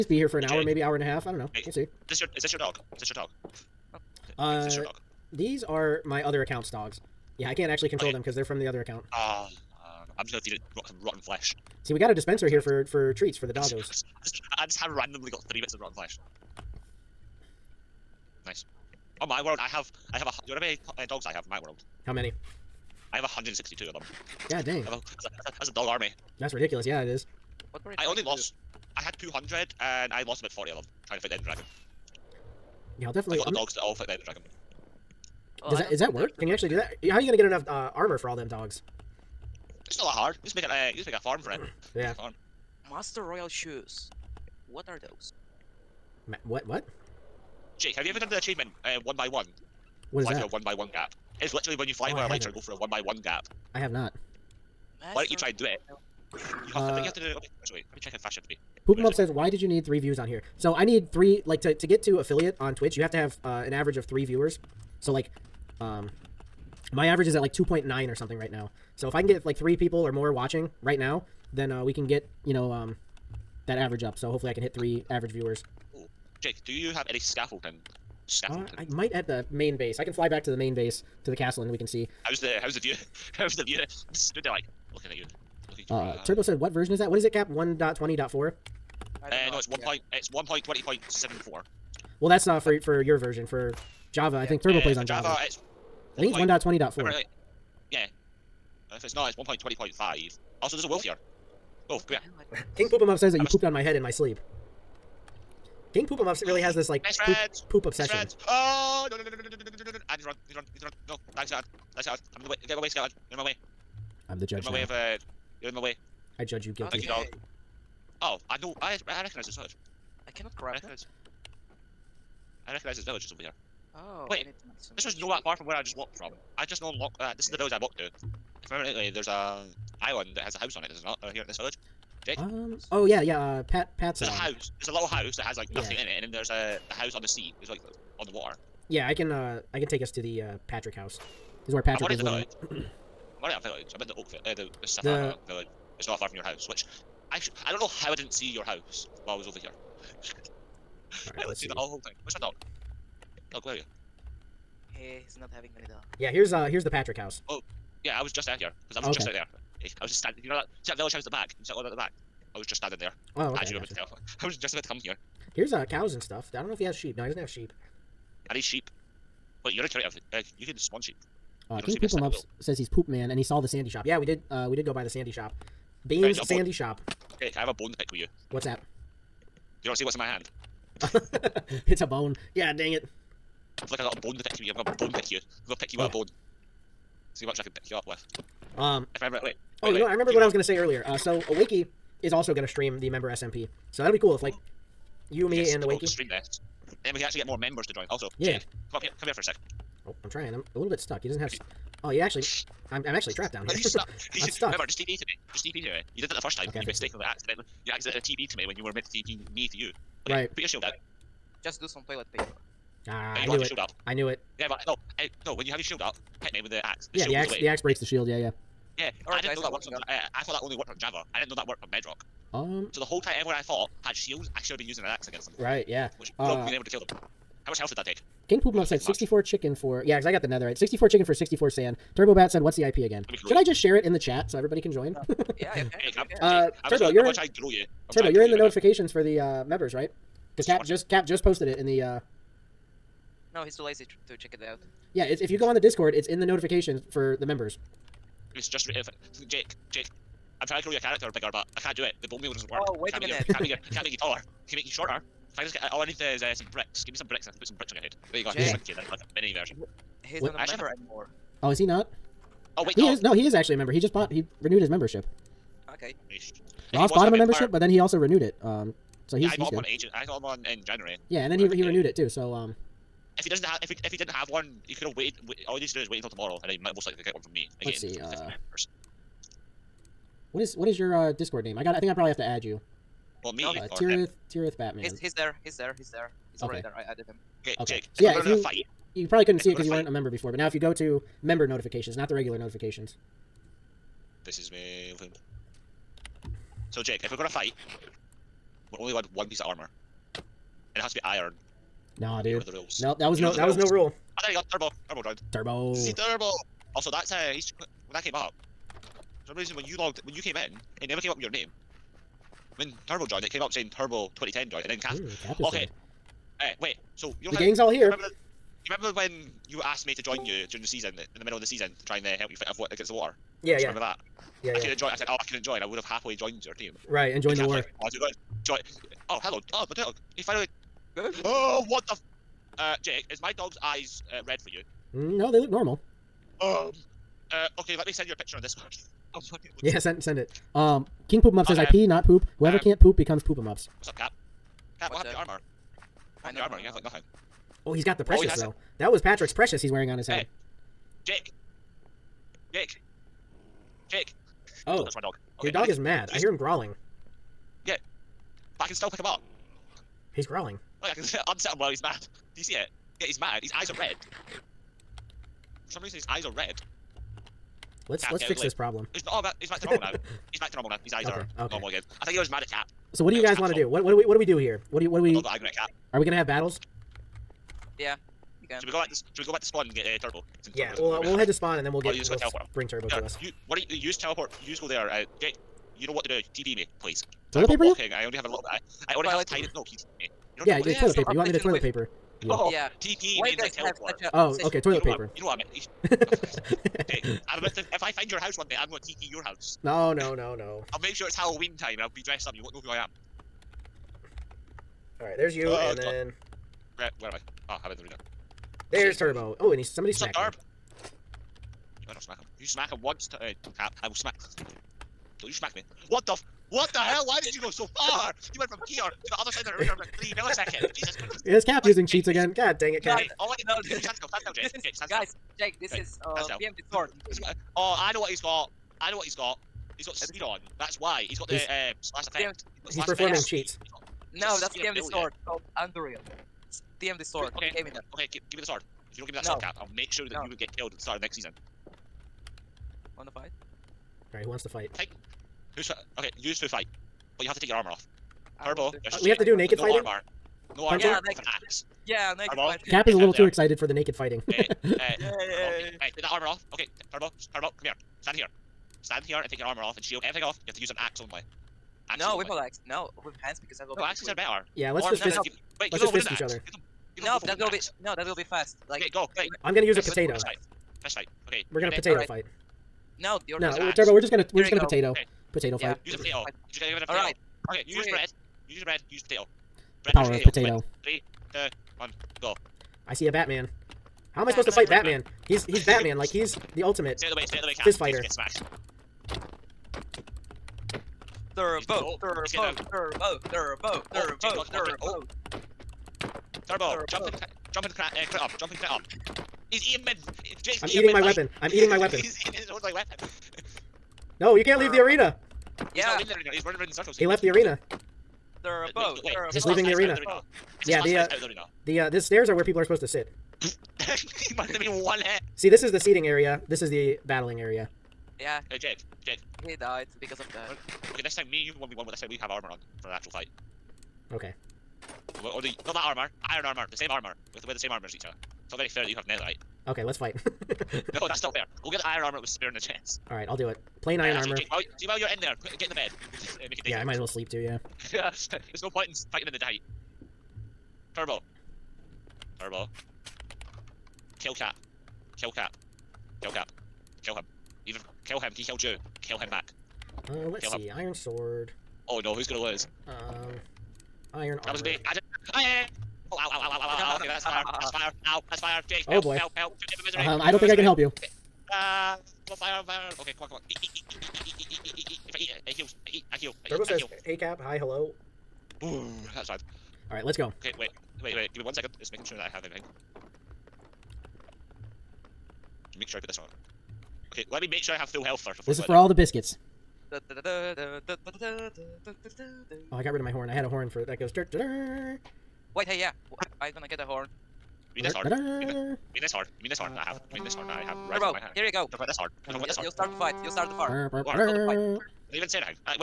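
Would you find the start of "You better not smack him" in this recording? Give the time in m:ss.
6:52.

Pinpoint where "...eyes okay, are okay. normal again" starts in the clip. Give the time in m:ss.
6:11.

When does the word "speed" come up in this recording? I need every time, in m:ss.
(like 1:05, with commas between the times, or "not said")
7:10.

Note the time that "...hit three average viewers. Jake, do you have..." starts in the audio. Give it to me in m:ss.
1:14.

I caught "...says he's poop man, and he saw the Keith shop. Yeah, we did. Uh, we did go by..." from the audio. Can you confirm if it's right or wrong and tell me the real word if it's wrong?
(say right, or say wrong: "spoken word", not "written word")
wrong: "Sandy", not "Keith".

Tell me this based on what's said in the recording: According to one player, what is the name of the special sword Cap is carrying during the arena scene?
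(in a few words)
Anduriel.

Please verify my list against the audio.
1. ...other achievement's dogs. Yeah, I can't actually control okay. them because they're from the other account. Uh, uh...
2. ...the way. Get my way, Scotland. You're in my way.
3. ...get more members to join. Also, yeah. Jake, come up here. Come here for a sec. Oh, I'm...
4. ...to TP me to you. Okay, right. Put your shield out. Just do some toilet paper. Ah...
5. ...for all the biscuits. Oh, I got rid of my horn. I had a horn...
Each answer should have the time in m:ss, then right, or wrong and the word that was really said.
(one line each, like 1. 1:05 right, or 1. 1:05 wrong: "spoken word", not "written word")
1. 0:06 wrong: "account", not "achievement"
2. 1:52 right
3. 3:17 right
4. 3:29 right
5. 9:38 right.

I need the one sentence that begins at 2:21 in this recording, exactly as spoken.
This is where Patrick I'm is living.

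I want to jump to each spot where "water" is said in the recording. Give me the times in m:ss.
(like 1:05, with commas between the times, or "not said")
2:18, 5:23.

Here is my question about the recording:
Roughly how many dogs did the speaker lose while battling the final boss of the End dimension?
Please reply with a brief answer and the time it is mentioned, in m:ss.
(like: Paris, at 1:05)
40, at 0:30.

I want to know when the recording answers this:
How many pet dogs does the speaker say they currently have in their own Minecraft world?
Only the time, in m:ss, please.
0:23.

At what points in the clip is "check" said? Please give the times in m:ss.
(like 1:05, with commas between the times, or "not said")
0:58, 4:04.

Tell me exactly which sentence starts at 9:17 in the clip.
okay, that's fire, that's fire, ow, that's fire, Jake, help, oh boy.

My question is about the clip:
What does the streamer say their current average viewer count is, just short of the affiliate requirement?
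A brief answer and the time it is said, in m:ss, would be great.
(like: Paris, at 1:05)
2.9, at 1:07.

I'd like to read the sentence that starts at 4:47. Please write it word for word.
Jake, so yeah, if you fight, you probably couldn't see it because you fight.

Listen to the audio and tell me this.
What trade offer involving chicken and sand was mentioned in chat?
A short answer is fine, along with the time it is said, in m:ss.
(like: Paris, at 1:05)
64 chicken for 64 sand, at 3:50.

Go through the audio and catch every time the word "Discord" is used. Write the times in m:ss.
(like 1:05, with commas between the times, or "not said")
4:05, 4:41.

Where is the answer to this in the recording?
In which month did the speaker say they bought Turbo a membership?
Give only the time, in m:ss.
4:30.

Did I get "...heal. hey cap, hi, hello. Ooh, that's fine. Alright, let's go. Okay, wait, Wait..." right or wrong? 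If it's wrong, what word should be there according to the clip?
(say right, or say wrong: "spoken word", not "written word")
right.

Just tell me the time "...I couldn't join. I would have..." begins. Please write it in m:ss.
5:25.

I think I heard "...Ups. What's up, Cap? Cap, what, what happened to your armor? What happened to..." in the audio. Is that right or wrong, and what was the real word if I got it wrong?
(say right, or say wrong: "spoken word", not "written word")
right.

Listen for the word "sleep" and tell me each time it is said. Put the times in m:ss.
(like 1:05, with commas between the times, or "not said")
1:44, 8:57.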